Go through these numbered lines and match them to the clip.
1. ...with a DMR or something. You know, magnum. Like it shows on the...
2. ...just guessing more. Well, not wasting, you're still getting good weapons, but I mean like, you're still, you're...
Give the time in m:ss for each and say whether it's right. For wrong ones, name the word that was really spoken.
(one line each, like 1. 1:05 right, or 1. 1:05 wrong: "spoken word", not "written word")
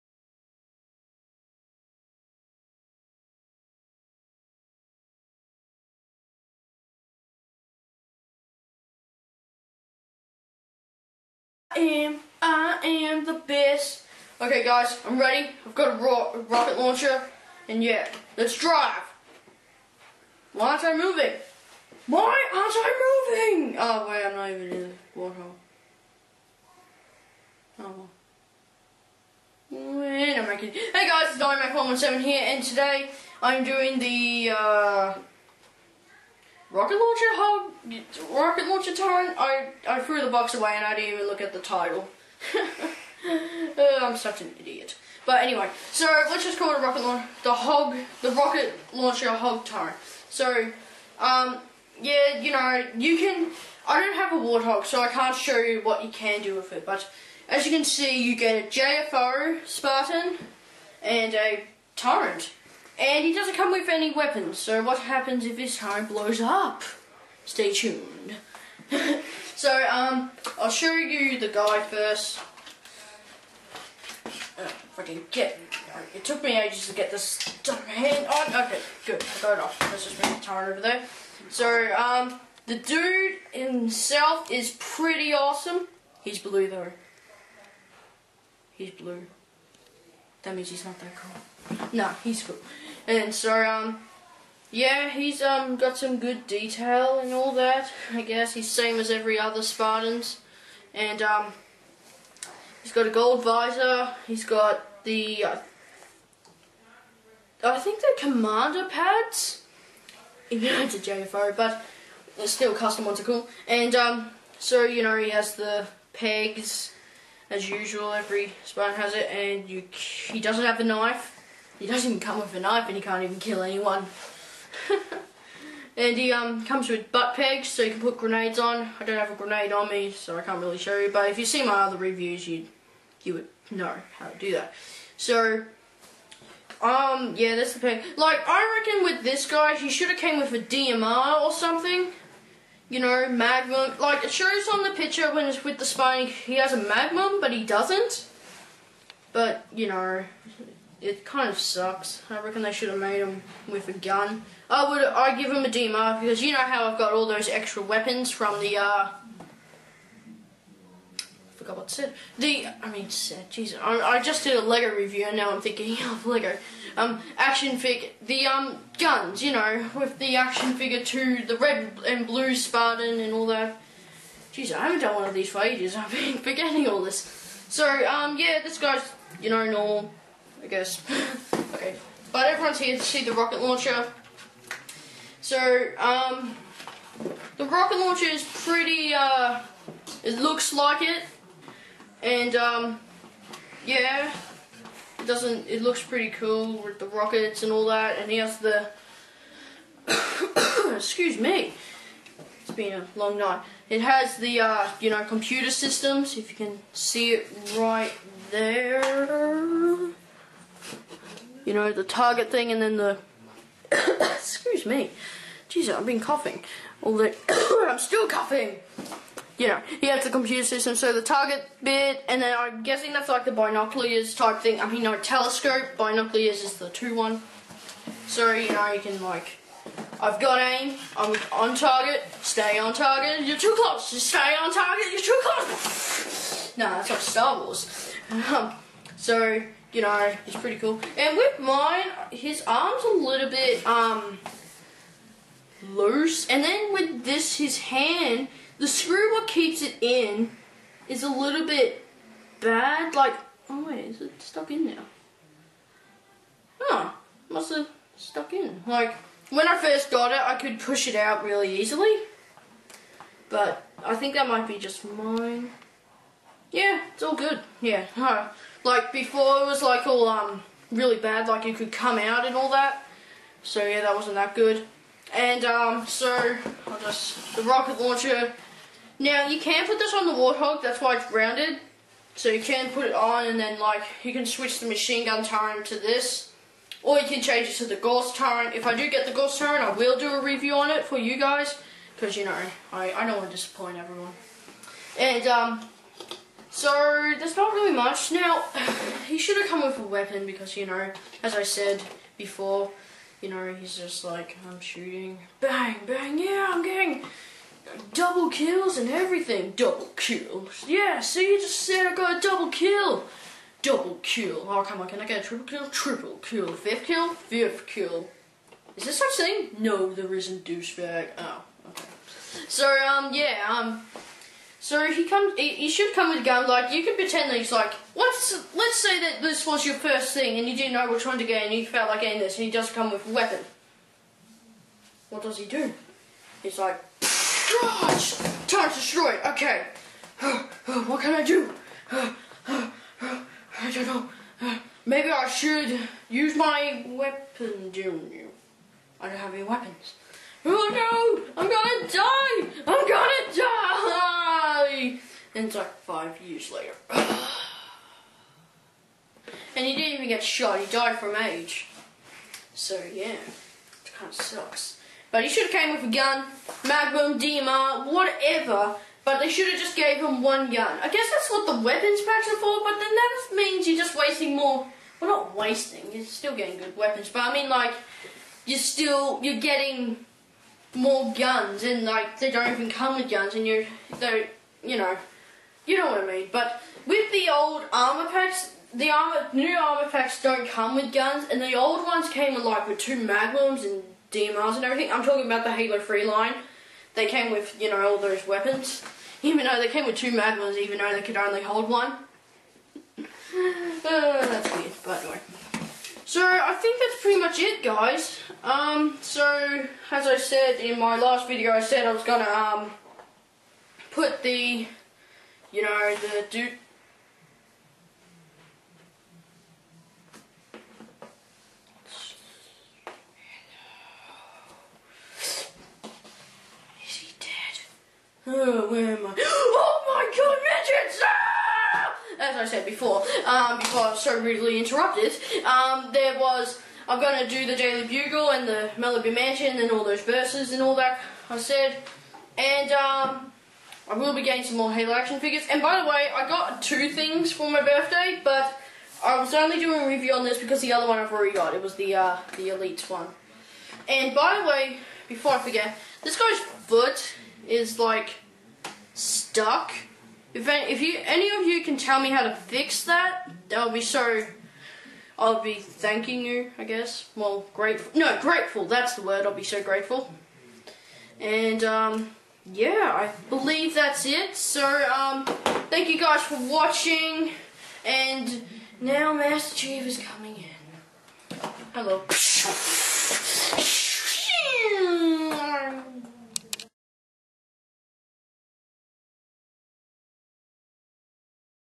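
1. 2:20 right
2. 6:13 wrong: "wasting", not "guessing".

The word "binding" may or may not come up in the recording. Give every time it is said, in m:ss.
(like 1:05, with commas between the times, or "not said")
not said.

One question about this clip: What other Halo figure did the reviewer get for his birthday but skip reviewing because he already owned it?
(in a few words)
The Elite.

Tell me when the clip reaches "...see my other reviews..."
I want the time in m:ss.
2:11.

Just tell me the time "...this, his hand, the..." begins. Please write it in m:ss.
4:07.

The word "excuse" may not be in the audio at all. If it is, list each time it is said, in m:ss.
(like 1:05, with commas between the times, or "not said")
3:20, 3:34.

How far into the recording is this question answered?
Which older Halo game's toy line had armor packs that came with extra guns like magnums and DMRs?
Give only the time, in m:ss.
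6:35.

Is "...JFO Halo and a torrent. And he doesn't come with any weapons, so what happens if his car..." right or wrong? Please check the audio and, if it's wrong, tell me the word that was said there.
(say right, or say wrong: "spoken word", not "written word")
wrong: "Spartan", not "Halo".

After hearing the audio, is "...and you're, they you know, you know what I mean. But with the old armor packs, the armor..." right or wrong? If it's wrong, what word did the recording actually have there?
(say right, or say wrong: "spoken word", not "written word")
right.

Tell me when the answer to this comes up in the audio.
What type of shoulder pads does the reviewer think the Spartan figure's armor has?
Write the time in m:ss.
1:48.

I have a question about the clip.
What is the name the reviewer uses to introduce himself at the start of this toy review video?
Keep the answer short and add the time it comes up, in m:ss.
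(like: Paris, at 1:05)
dynamac Seven, at 0:31.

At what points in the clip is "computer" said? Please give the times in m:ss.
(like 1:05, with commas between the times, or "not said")
3:25, 3:40.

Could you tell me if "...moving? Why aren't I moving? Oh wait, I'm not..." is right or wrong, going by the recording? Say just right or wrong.
right.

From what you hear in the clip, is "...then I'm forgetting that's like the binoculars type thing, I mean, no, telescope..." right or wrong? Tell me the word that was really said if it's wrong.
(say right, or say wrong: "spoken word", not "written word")
wrong: "guessing", not "forgetting".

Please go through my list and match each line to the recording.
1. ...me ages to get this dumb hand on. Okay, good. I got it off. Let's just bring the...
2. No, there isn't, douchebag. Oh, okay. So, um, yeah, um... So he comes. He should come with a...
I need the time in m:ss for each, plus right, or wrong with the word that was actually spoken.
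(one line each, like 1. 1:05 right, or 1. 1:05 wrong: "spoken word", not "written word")
1. 1:16 right
2. 5:19 right.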